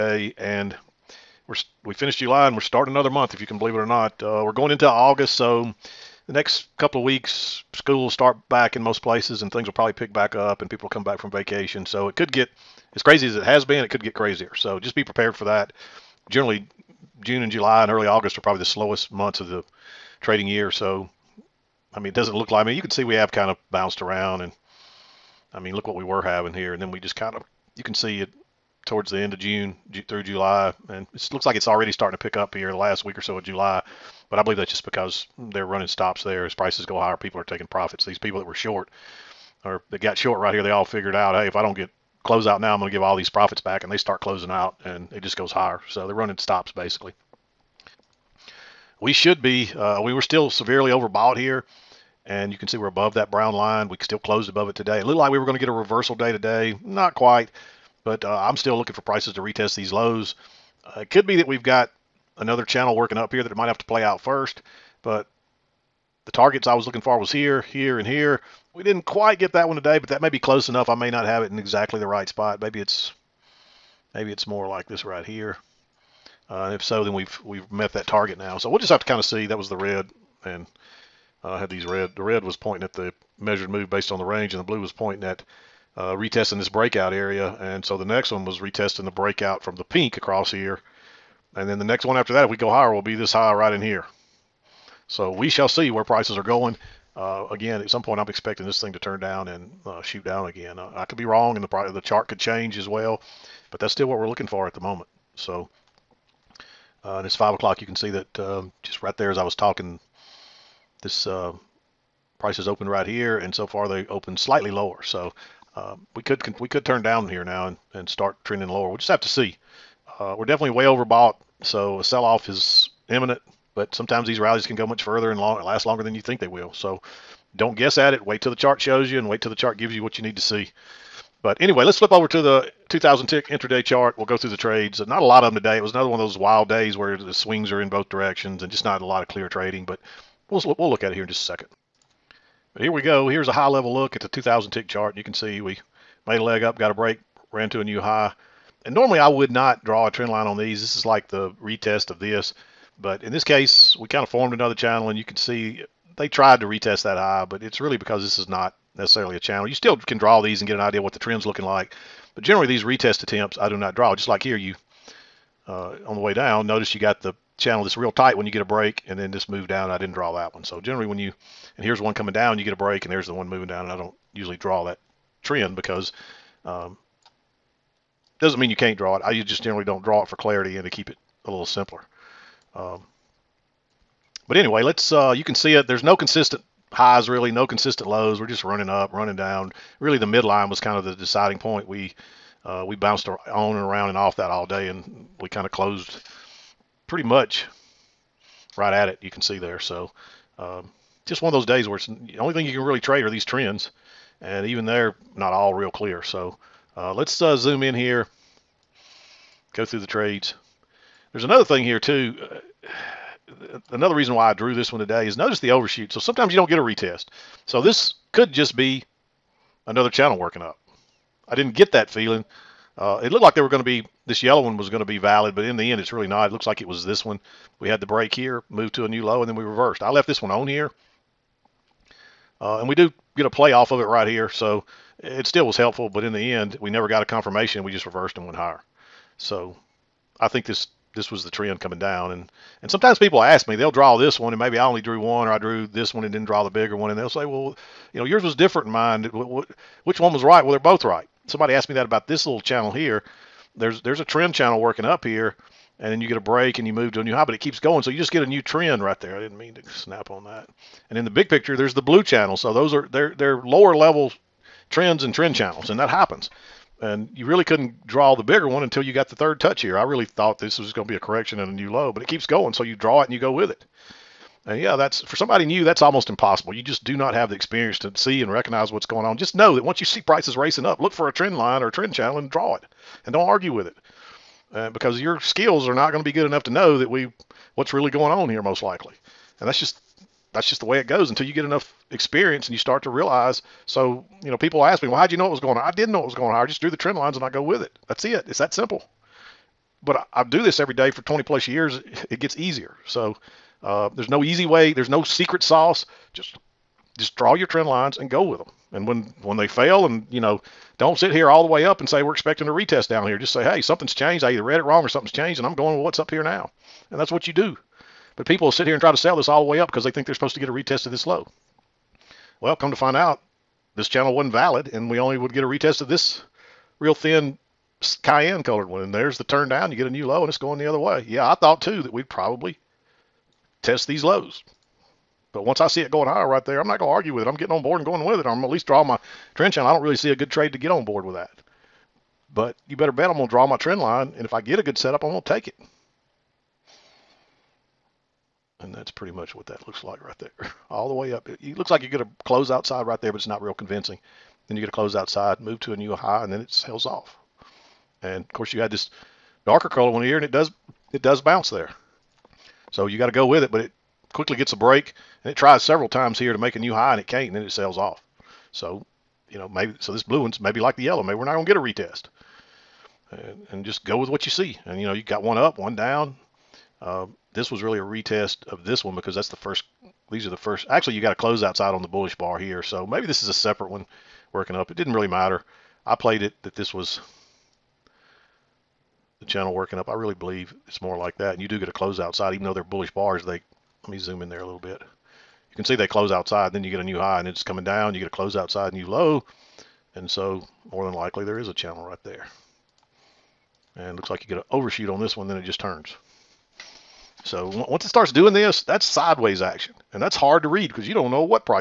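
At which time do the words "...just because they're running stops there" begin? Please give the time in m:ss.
0:34.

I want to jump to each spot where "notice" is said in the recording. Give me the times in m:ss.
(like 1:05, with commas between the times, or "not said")
2:46, 3:35.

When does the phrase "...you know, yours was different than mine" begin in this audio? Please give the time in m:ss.
4:08.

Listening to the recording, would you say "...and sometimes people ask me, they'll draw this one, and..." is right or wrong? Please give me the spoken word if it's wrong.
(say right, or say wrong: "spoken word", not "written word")
right.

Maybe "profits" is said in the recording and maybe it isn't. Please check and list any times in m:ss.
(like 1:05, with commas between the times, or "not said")
0:37, 0:43.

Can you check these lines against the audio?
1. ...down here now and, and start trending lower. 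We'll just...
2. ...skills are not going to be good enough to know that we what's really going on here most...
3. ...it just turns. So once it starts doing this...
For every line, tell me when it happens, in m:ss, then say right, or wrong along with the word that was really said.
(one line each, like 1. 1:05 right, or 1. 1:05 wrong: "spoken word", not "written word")
1. 1:57 right
2. 4:45 right
3. 6:45 right.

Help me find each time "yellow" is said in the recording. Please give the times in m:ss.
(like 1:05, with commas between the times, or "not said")
3:44, 6:11.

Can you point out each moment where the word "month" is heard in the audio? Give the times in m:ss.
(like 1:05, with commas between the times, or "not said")
0:03, 0:19.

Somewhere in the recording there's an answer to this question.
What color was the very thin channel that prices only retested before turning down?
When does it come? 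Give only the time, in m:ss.
5:28.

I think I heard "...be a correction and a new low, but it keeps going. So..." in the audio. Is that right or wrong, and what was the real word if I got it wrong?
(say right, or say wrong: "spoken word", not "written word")
right.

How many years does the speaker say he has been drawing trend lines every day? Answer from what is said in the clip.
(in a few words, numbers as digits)
20 plus years.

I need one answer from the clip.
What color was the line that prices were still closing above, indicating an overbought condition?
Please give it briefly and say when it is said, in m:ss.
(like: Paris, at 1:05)
brown, at 0:53.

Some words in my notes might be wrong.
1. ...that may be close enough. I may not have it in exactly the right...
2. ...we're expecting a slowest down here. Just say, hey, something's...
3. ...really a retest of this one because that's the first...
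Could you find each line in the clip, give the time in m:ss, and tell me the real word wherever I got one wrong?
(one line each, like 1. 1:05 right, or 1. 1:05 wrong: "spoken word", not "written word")
1. 1:10 right
2. 5:12 wrong: "retest", not "slowest"
3. 6:17 right.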